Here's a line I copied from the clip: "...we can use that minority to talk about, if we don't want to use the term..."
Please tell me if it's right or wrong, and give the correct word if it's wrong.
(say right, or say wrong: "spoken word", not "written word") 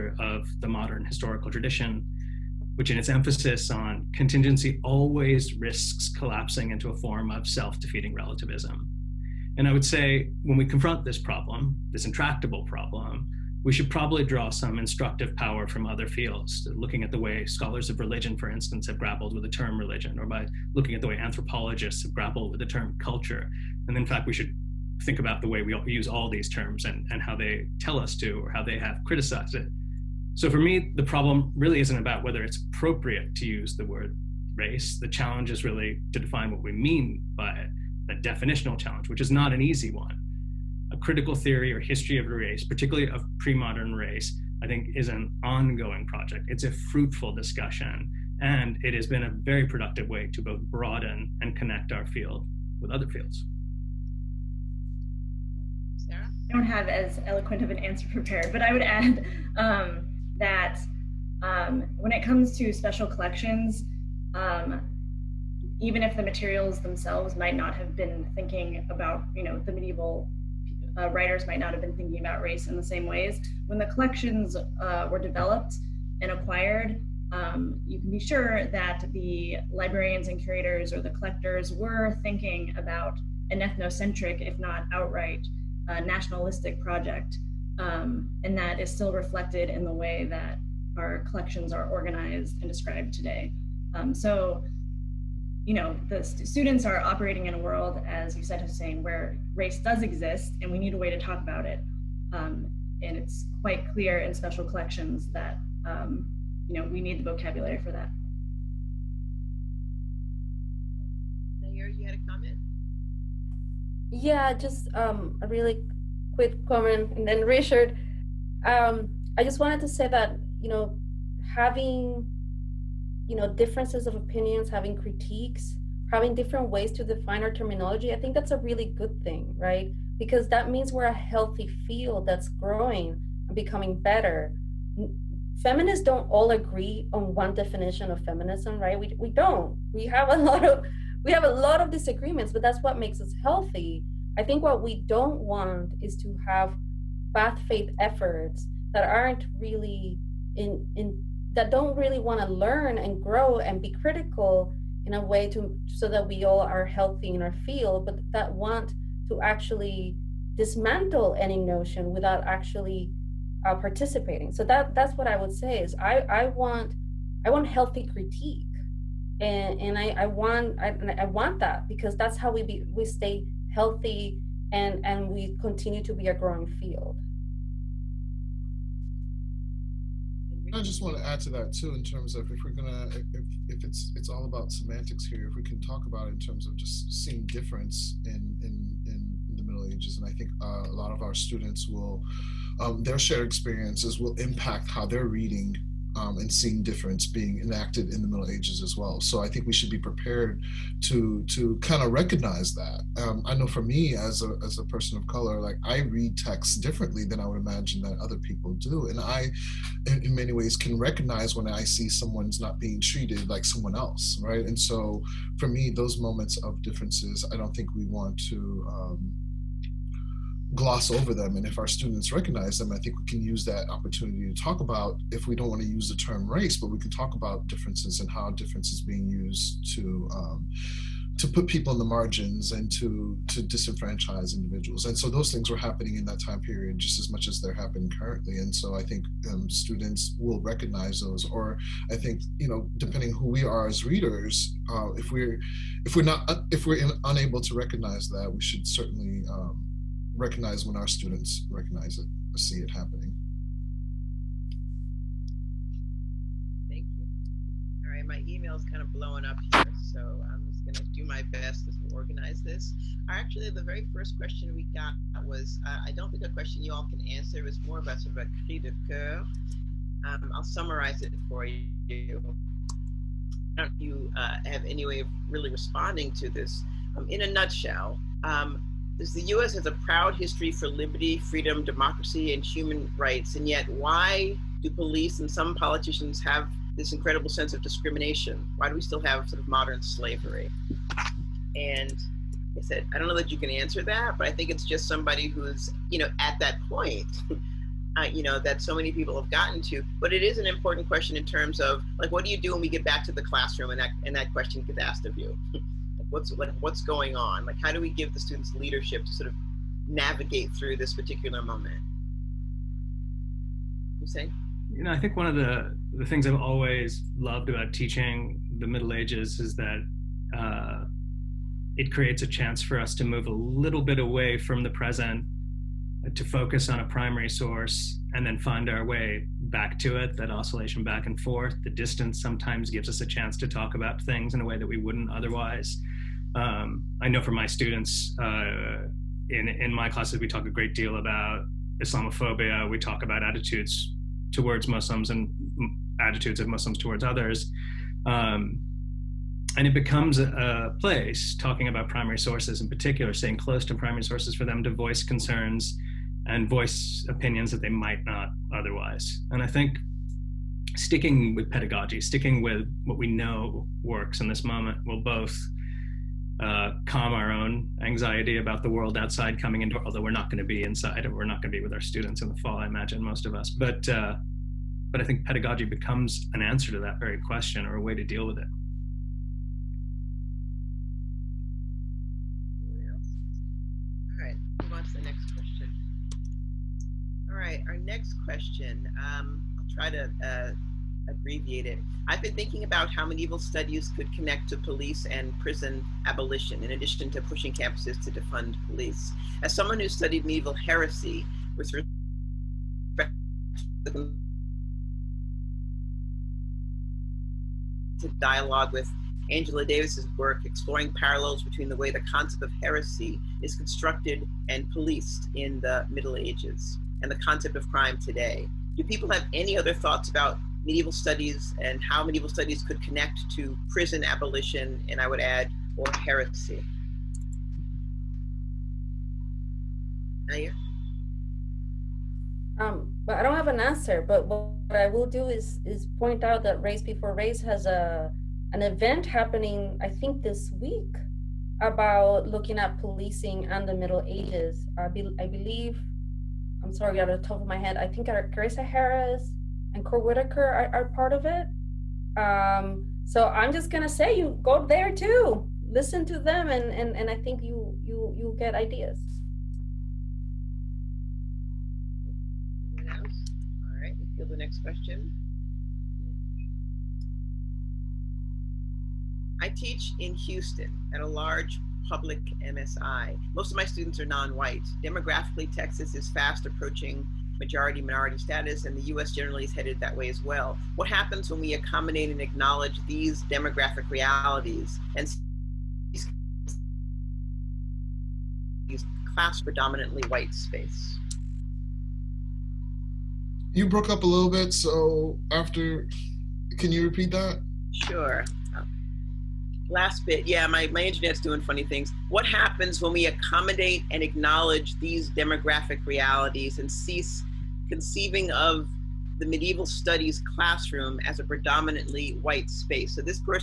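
wrong: "opportunity", not "minority".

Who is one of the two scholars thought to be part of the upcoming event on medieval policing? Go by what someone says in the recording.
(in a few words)
Cord Whitaker.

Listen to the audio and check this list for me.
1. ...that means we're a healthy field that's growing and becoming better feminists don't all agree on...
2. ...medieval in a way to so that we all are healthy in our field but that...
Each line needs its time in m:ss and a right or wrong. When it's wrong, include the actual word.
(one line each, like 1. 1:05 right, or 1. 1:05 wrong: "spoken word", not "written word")
1. 2:10 right
2. 2:33 wrong: "critical", not "medieval".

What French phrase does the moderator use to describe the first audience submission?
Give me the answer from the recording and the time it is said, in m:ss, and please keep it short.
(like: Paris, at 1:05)
cri de coeur, at 4:28.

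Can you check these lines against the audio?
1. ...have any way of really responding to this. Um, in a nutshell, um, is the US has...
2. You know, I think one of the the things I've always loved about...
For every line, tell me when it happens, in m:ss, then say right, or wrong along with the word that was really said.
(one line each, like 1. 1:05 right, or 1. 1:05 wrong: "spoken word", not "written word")
1. 4:34 right
2. 5:14 right.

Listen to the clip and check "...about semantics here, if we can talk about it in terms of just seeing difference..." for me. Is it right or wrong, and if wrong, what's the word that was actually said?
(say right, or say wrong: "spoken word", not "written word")
right.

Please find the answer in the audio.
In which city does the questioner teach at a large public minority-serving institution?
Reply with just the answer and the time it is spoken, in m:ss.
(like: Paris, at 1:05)
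Houston, at 7:50.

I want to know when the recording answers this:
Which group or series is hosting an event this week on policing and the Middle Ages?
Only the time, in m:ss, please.
7:16.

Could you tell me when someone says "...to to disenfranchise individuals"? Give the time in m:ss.
3:52.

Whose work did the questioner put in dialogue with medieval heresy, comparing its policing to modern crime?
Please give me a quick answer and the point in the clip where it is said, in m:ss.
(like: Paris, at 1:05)
Angela Davis, at 6:49.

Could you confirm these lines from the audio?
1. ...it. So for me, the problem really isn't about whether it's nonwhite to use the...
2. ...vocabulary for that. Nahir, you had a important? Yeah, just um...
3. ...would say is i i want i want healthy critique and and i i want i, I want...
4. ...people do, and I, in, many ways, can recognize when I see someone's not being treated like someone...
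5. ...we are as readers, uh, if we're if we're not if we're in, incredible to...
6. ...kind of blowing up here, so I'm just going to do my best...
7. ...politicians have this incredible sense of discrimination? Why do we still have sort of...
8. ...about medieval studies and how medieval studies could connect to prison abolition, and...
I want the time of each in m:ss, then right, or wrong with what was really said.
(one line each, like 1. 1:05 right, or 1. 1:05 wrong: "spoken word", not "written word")
1. 0:29 wrong: "appropriate", not "nonwhite"
2. 1:47 wrong: "comment", not "important"
3. 2:45 right
4. 3:28 right
5. 4:03 wrong: "unable", not "incredible"
6. 4:18 right
7. 4:45 right
8. 7:00 right.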